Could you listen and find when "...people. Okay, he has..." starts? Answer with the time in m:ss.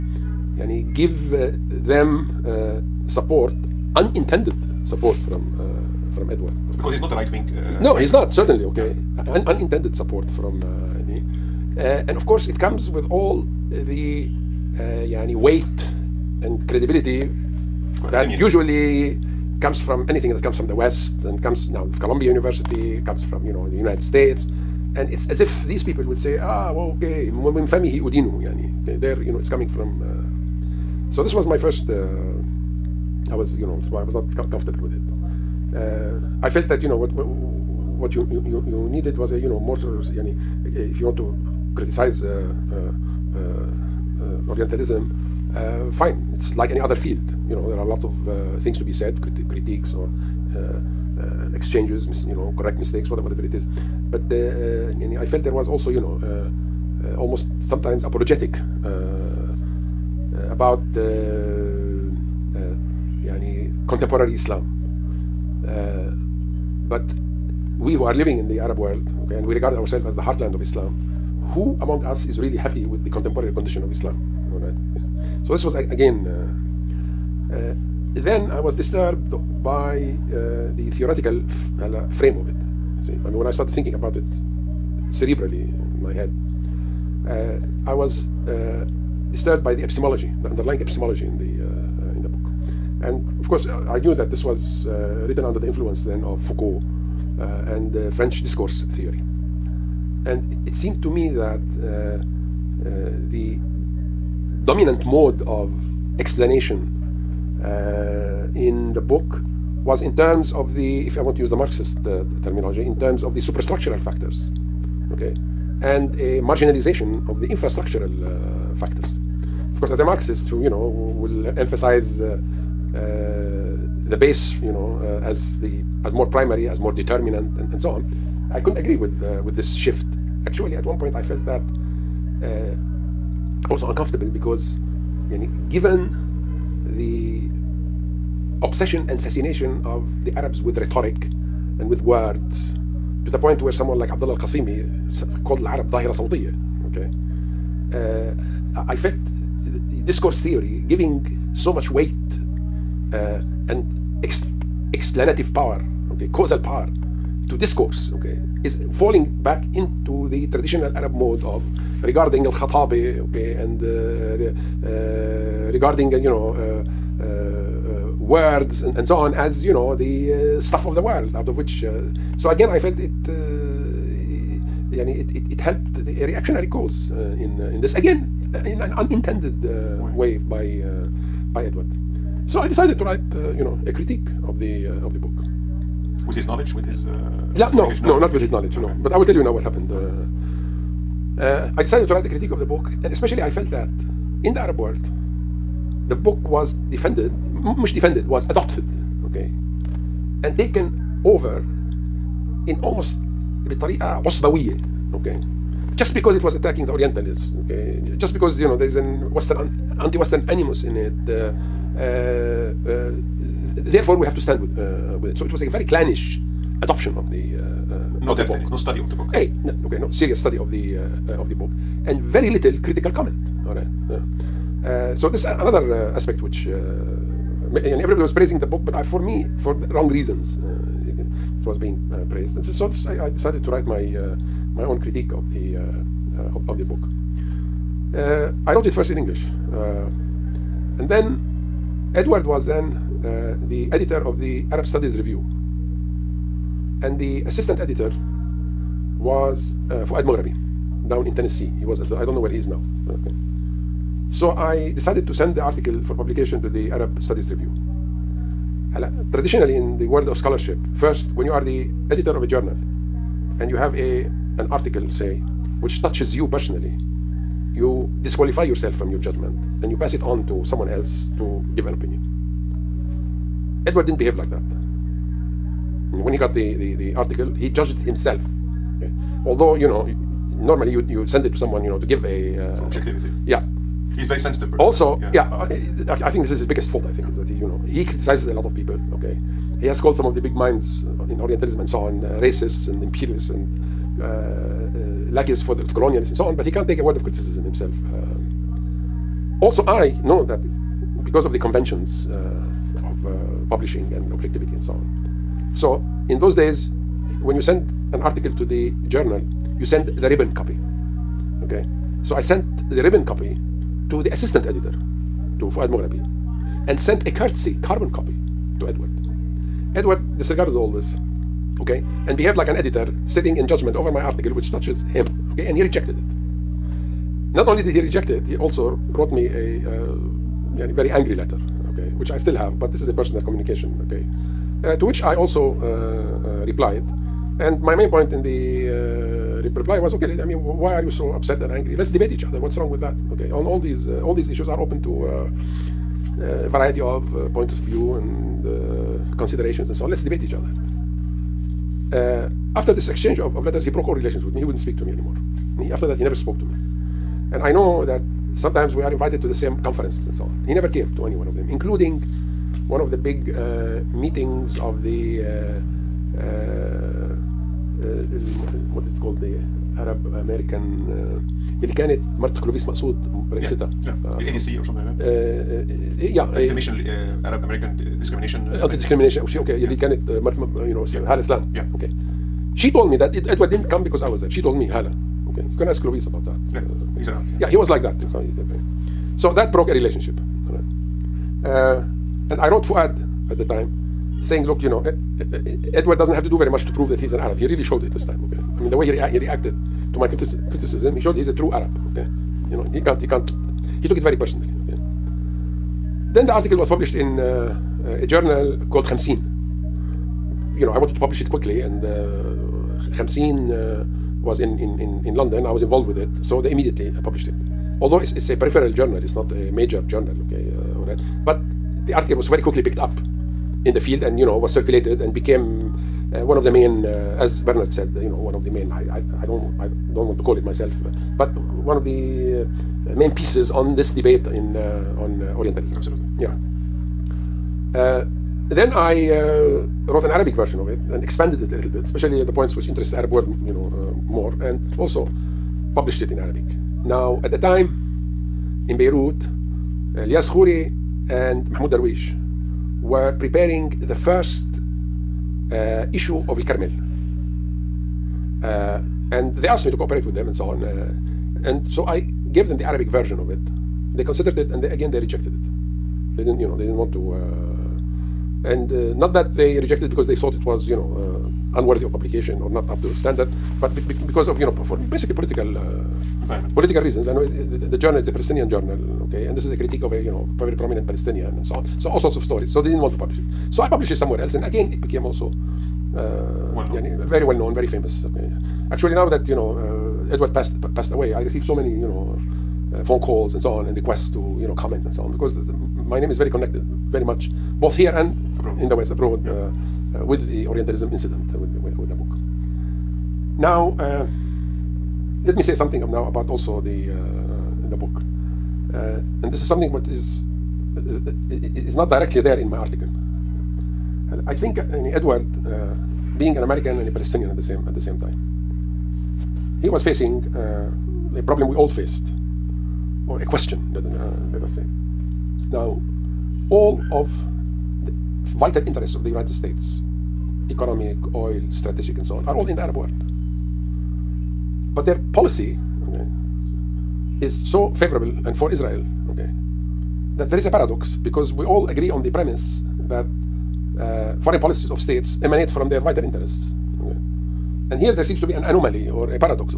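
4:48.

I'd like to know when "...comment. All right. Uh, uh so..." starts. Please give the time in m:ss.
3:43.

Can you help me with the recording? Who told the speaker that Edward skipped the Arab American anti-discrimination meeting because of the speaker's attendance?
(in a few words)
Hala.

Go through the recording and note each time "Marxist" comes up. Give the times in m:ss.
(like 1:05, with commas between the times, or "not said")
1:51, 2:00.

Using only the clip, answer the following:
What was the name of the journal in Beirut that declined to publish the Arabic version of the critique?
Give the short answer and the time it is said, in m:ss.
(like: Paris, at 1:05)
El Carmel, at 7:36.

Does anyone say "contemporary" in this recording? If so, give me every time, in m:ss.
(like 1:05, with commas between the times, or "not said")
1:03, 1:13.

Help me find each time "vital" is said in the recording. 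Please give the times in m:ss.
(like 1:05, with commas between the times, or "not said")
8:48, 9:06.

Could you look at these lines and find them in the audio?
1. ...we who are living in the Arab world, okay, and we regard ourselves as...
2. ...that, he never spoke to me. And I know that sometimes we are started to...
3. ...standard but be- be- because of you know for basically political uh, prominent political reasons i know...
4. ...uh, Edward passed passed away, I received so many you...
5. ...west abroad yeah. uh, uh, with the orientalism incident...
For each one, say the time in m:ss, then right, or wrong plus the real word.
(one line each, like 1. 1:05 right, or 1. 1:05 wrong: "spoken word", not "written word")
1. 1:07 right
2. 5:56 wrong: "invited", not "started"
3. 7:53 wrong: "environment", not "prominent"
4. 8:09 right
5. 8:18 right.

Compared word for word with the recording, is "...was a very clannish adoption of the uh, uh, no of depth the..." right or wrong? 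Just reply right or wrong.
right.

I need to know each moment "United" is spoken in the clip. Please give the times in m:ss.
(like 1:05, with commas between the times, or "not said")
0:23, 8:49.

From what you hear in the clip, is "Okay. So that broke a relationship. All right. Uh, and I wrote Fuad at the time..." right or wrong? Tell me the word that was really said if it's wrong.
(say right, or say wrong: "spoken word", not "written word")
right.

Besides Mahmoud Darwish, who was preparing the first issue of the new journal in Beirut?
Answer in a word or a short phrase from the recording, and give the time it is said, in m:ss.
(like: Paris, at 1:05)
Elias Khouri, at 7:30.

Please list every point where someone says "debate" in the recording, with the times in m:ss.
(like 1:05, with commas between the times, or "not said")
5:42, 5:50, 7:14.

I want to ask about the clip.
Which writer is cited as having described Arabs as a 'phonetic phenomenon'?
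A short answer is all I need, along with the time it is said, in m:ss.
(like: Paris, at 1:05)
Abdullah al Qasimi, at 2:24.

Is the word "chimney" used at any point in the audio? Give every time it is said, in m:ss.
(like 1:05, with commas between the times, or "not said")
not said.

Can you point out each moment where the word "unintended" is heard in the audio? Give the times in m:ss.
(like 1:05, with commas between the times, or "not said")
0:03, 0:09, 2:58.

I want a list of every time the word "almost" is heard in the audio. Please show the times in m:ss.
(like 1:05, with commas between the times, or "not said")
0:57, 3:22.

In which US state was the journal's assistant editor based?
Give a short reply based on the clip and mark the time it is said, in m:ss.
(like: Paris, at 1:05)
Tennessee, at 4:11.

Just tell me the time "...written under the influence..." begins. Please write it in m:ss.
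1:34.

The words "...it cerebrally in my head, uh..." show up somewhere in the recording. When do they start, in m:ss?
1:24.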